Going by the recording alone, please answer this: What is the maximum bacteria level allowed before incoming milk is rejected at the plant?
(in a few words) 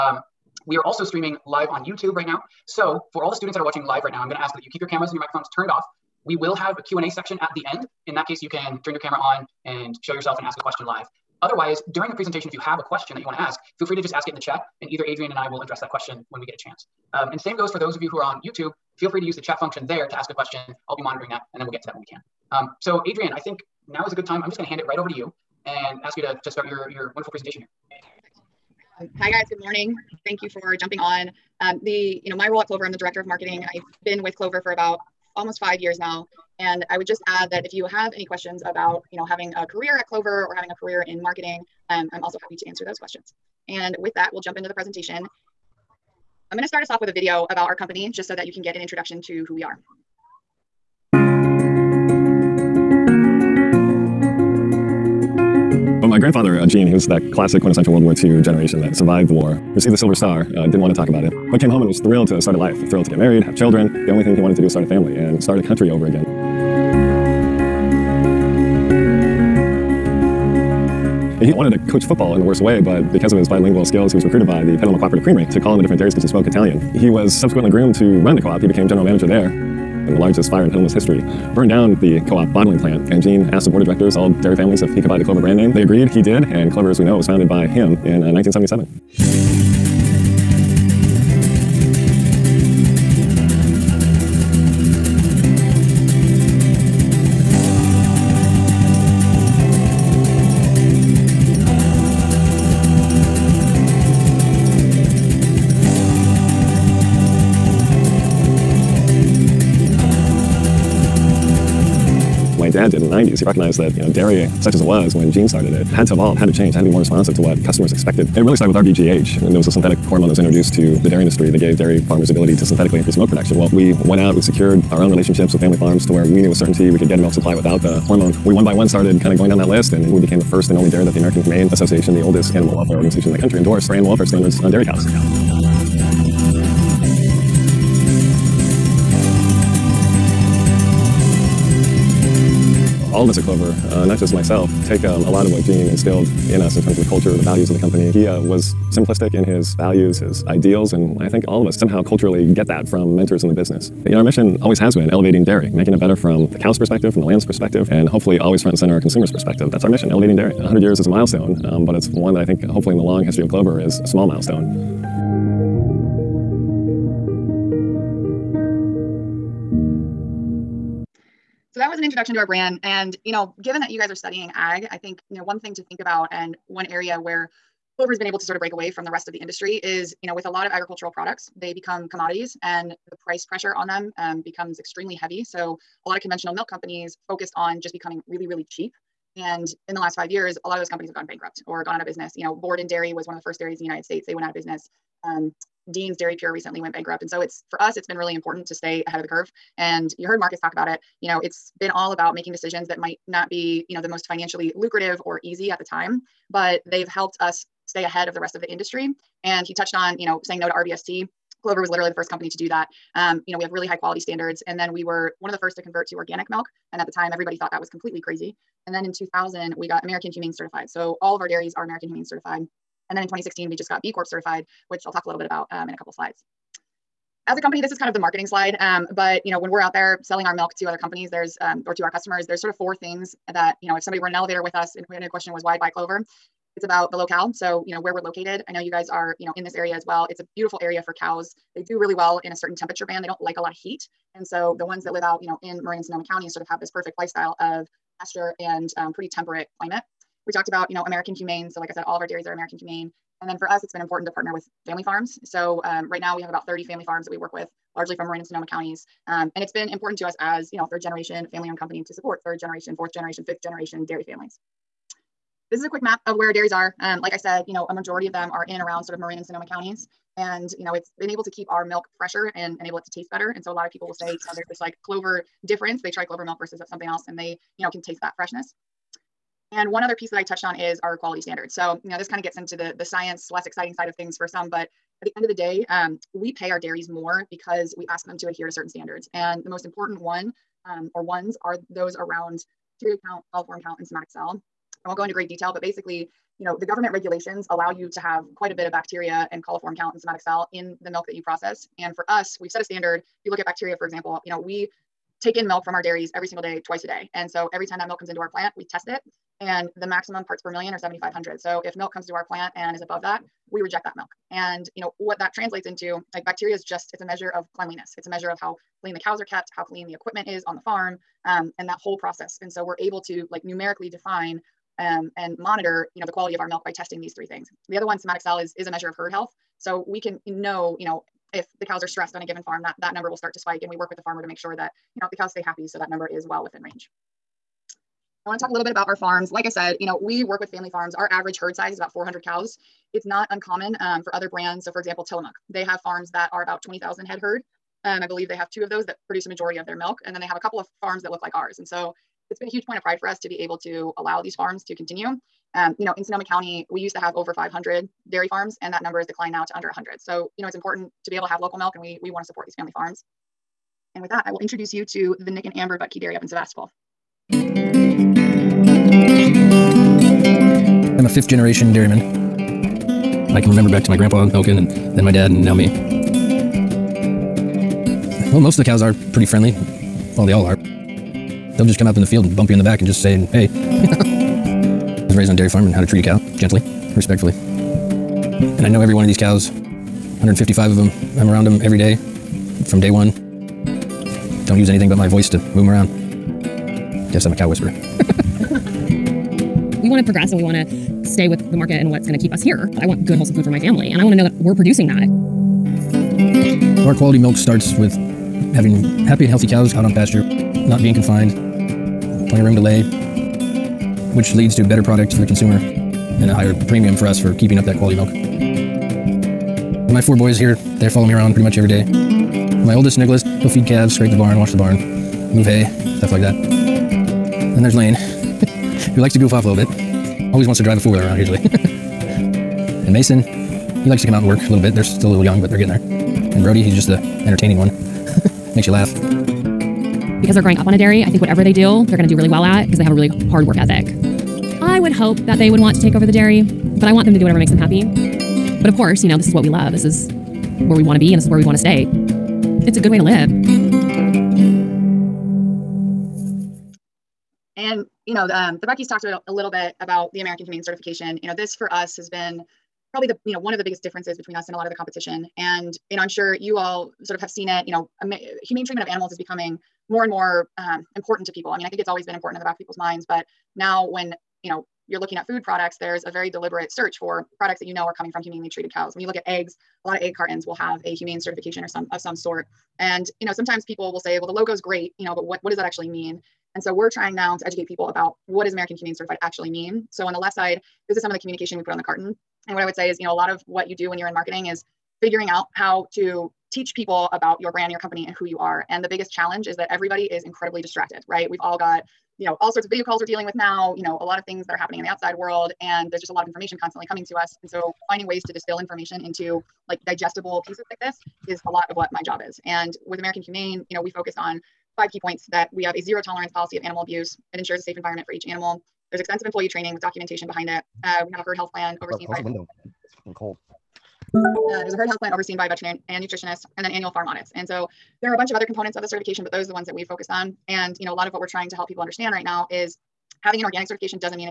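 7,500.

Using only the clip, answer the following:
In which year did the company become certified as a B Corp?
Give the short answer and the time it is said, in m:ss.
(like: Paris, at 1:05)
2016, at 3:43.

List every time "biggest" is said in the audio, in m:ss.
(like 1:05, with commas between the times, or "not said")
7:43, 8:19.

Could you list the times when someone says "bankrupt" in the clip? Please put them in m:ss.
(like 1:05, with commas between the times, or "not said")
3:11, 3:16.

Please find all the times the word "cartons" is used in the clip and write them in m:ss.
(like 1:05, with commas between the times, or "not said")
8:00, 8:12.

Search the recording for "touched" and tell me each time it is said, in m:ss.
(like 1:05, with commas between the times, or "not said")
3:29, 4:40.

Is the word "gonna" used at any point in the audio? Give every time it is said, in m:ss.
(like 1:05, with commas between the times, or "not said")
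0:04, 0:46.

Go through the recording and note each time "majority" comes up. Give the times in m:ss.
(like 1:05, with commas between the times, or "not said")
4:27, 5:49.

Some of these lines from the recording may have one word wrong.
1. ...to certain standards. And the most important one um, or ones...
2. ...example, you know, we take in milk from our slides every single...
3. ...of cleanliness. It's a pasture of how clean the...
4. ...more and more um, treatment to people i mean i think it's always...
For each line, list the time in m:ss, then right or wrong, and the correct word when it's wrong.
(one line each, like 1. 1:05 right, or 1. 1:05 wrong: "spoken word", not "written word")
1. 4:48 right
2. 5:04 wrong: "dairies", not "slides"
3. 5:17 wrong: "measure", not "pasture"
4. 7:50 wrong: "important", not "treatment".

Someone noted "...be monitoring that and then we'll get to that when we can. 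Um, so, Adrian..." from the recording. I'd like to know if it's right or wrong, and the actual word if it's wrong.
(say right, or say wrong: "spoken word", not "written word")
right.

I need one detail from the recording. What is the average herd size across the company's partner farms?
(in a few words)
about 400 cows.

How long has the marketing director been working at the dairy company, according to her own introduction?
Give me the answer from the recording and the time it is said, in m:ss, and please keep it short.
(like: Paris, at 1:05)
almost 5 years, at 0:35.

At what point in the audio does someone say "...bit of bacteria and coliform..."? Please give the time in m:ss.
4:58.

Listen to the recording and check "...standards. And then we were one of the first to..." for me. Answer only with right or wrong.
right.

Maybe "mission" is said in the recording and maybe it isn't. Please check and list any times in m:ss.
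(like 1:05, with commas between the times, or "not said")
2:34, 2:39.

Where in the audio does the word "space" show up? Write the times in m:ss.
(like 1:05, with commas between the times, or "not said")
not said.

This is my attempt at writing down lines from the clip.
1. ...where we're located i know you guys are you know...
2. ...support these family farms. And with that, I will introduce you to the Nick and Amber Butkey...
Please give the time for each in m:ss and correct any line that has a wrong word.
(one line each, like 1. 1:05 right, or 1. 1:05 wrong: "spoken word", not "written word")
1. 3:57 right
2. 6:02 right.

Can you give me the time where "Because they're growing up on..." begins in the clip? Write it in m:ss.
7:20.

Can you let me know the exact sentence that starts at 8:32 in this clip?
And with American Humane, you know, we focused on five key points that we have a zero tolerance policy of animal abuse.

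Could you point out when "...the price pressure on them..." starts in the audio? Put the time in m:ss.
3:03.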